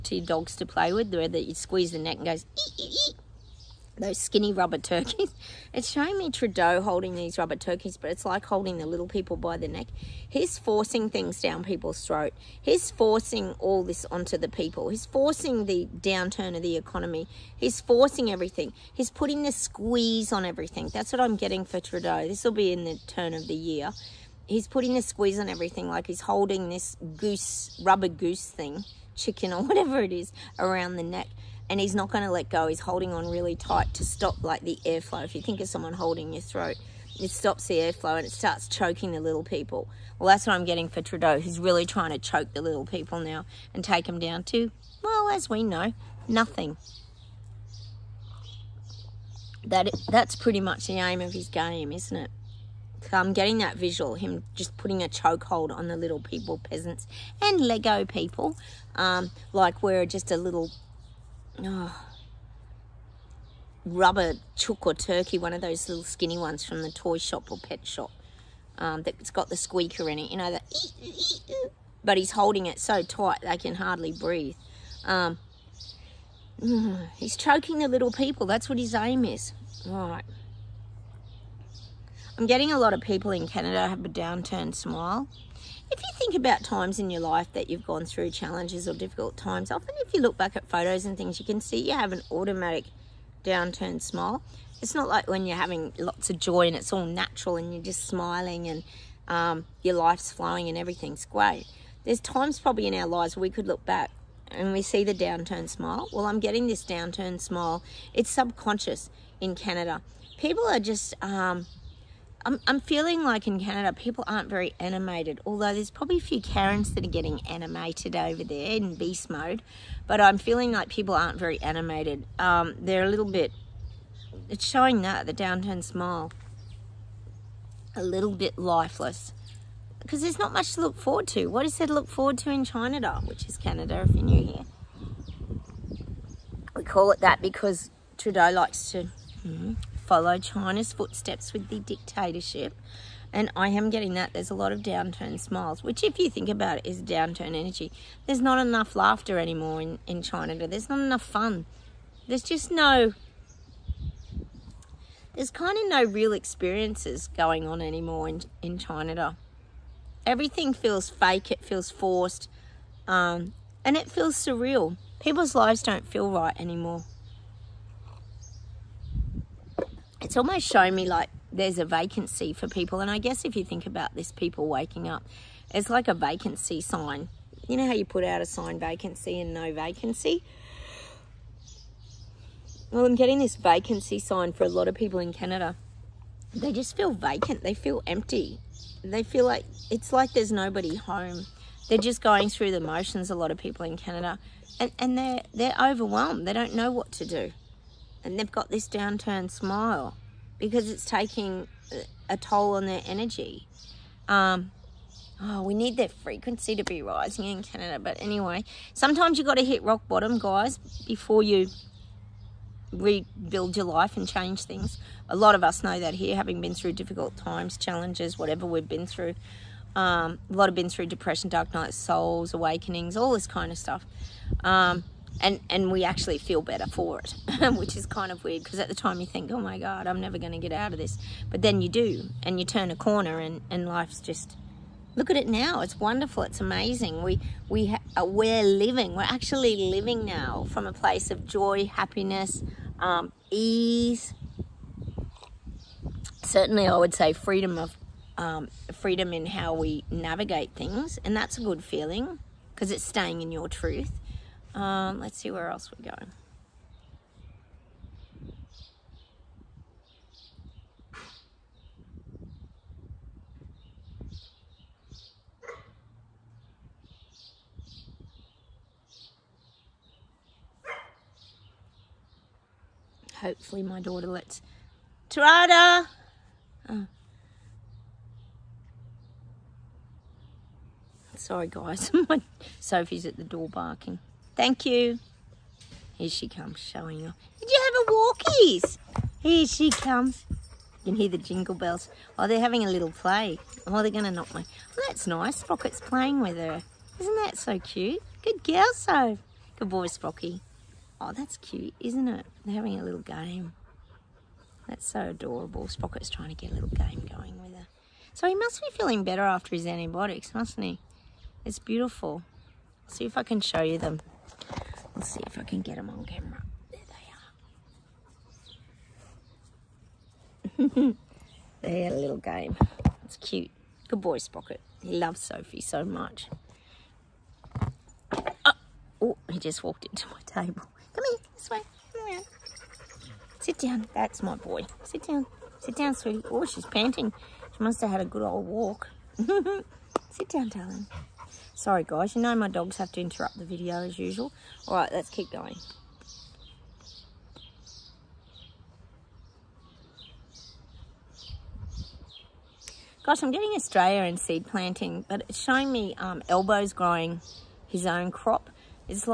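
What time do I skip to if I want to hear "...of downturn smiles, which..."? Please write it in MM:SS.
02:24.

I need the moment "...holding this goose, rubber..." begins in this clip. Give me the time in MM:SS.
00:26.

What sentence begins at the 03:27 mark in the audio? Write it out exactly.
But anyway, sometimes you've got to hit rock bottom, guys, before you rebuild your life and change things.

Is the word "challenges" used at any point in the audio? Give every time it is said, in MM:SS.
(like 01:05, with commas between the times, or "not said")
01:28, 03:37.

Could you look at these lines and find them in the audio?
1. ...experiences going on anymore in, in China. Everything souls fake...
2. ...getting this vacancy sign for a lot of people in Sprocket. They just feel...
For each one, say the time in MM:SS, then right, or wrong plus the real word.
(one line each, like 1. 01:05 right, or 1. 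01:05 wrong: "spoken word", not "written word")
1. 02:36 wrong: "feels", not "souls"
2. 03:03 wrong: "Canada", not "Sprocket".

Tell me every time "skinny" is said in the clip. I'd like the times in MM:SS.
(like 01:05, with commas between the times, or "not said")
00:04, 01:06.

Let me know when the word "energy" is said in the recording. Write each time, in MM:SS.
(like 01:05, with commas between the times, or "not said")
02:27, 03:23.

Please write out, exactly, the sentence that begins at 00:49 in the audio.
That That's pretty much the aim of his game, isn't it?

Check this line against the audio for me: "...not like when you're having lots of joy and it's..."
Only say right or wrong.
right.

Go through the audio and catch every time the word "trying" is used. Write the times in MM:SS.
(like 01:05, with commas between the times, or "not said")
00:41, 05:06.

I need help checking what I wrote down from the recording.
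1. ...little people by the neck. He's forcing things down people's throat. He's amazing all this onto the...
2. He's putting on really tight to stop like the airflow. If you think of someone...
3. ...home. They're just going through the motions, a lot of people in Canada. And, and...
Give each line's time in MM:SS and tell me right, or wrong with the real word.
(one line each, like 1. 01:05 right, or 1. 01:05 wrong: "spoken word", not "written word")
1. 00:08 wrong: "forcing", not "amazing"
2. 00:32 wrong: "holding", not "putting"
3. 03:10 right.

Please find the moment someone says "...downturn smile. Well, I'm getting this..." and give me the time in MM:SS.
01:45.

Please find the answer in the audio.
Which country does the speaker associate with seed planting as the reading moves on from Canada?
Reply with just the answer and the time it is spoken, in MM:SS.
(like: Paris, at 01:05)
Australia, at 05:53.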